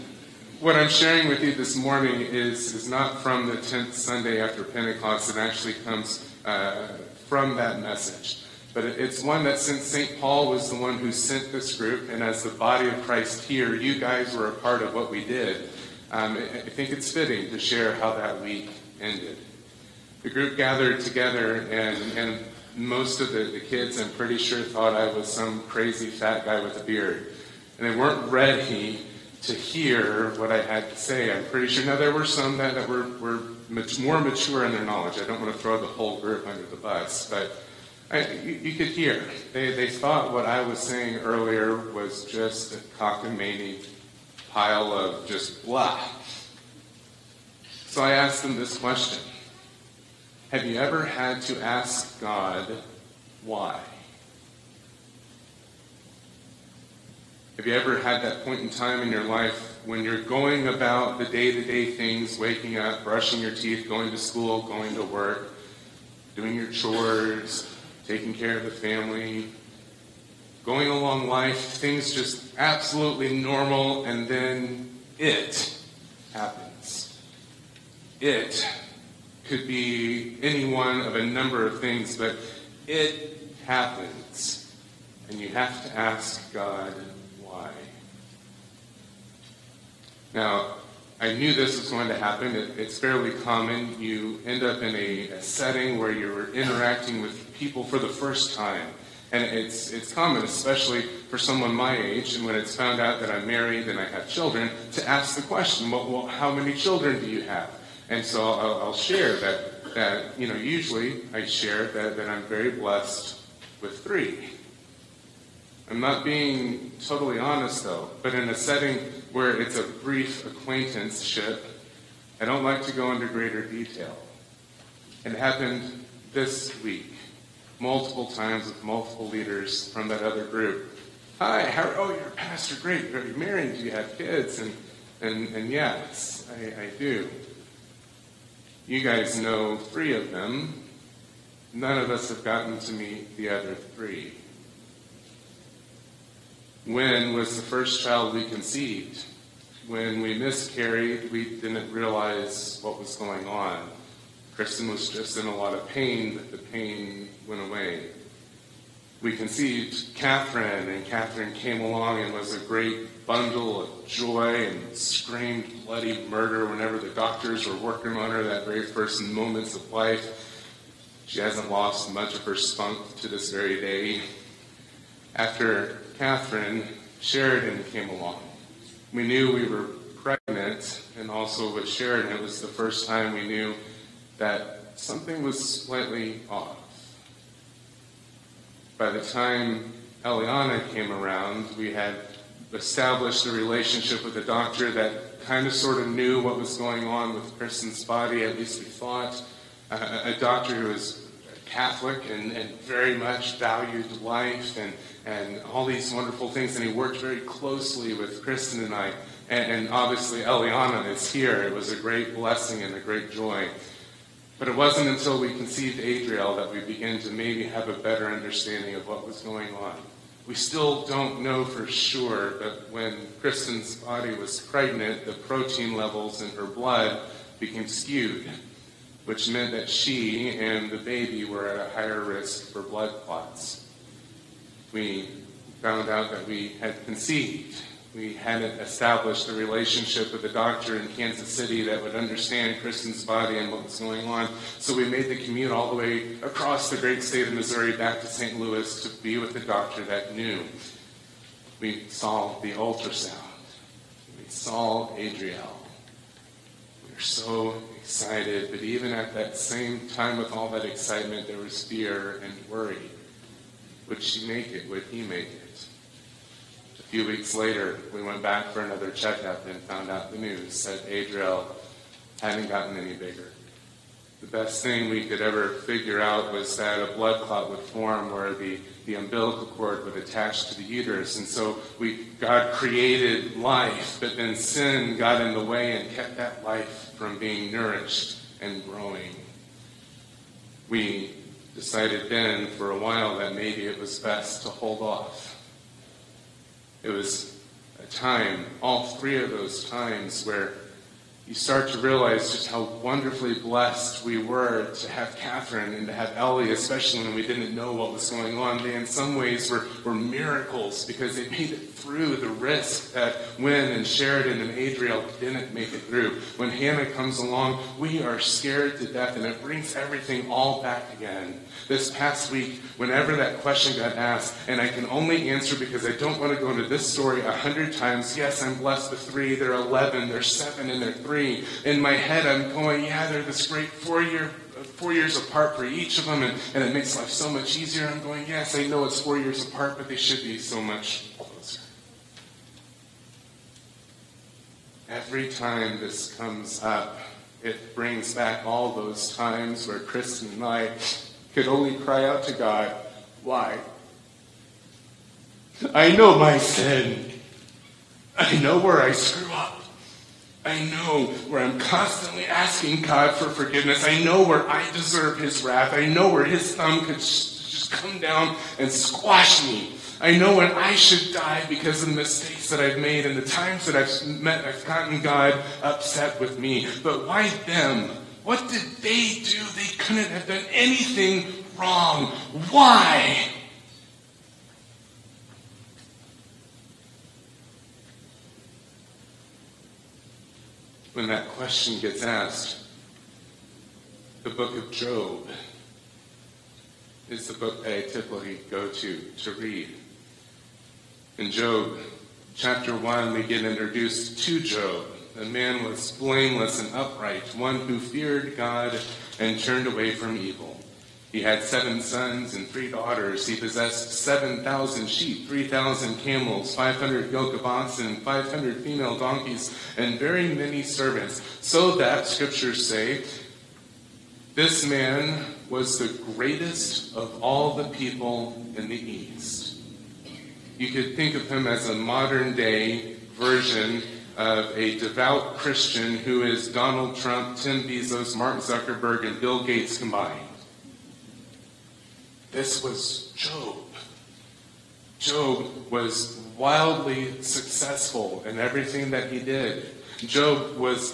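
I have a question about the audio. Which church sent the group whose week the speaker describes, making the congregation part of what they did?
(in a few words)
St. Paul.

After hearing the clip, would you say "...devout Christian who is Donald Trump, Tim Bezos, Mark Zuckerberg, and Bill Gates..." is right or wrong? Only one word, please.
right.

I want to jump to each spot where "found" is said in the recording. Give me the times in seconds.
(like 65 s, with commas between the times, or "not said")
102 s, 235 s, 269 s.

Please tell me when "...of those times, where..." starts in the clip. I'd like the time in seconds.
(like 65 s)
299 s.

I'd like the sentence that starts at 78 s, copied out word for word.
It could be any one of a number of things, but it happens.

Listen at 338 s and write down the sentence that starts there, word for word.
I'm going, yes, I know it's four years apart, but they should be so much closer.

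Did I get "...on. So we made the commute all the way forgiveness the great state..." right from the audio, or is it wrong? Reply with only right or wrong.
wrong.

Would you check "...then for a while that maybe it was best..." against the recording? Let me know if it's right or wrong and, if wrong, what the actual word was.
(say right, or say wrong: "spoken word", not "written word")
right.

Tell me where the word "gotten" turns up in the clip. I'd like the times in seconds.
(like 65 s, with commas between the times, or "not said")
142 s, 272 s, 374 s.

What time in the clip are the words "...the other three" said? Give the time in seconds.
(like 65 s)
143 s.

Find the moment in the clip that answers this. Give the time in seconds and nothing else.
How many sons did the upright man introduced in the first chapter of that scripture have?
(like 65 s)
411 s.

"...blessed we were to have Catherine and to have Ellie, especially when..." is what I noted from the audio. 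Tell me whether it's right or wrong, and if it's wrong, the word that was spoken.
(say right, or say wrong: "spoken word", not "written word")
right.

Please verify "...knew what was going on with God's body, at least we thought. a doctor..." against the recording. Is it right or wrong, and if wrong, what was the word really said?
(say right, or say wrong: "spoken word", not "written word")
wrong: "Kristen", not "God".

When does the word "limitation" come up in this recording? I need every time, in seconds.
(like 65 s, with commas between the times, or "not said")
not said.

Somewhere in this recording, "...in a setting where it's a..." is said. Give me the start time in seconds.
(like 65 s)
118 s.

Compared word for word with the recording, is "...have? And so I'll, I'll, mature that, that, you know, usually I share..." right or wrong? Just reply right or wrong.
wrong.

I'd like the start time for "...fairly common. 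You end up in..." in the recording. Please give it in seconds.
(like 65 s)
92 s.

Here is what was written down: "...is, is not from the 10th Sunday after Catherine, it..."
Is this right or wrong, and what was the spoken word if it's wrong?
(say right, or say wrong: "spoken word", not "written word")
wrong: "Pentecost", not "Catherine".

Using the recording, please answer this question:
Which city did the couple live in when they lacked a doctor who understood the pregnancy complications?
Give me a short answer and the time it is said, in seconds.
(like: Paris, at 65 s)
Kansas City, at 241 s.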